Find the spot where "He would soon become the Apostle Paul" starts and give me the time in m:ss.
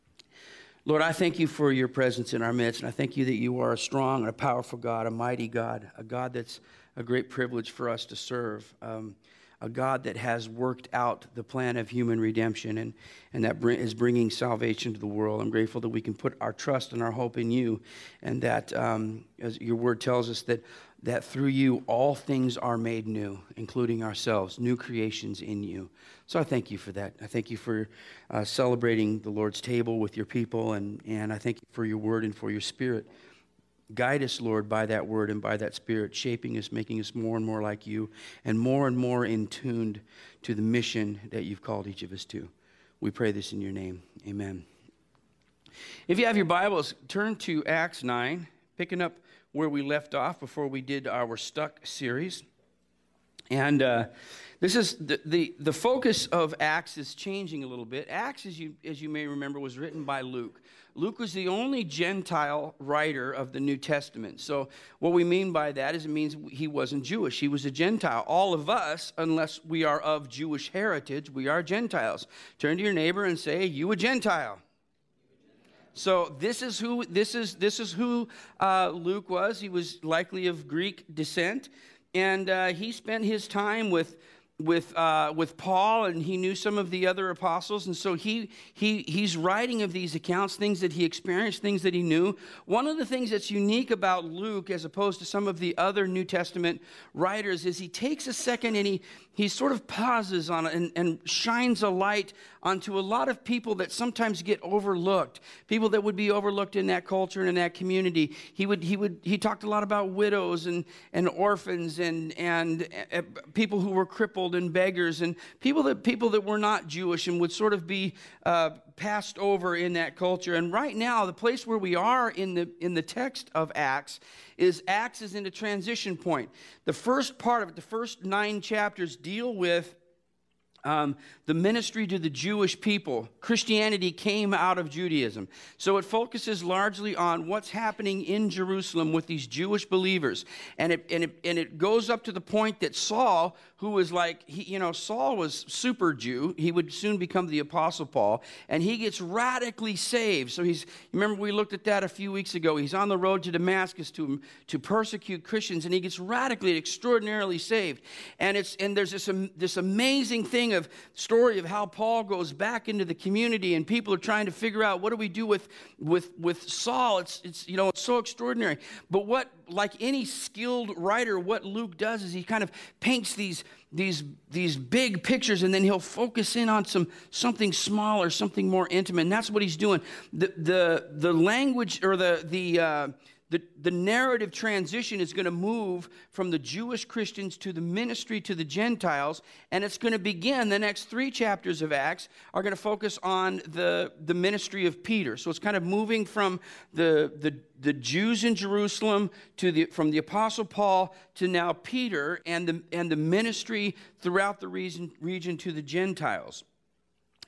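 2:26.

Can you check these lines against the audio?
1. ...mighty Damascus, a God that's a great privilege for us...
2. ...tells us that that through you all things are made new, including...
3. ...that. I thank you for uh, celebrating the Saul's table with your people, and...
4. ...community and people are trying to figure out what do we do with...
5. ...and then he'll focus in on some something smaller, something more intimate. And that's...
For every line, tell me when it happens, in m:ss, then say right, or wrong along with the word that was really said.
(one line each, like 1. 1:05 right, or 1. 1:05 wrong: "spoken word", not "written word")
1. 0:05 wrong: "God", not "Damascus"
2. 0:20 right
3. 0:26 wrong: "Lord", not "Saul"
4. 2:43 right
5. 2:55 right.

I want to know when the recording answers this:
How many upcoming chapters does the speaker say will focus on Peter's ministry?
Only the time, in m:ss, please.
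3:11.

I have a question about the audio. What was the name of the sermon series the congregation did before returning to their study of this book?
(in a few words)
Stuck.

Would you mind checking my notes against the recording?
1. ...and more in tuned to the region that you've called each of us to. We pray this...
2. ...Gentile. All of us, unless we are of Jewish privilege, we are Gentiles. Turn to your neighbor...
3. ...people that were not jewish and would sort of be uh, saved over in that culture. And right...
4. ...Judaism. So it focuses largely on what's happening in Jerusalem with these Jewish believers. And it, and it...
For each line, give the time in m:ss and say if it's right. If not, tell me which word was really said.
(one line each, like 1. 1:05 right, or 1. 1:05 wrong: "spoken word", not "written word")
1. 0:38 wrong: "mission", not "region"
2. 1:07 wrong: "heritage", not "privilege"
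3. 1:56 wrong: "passed", not "saved"
4. 2:14 right.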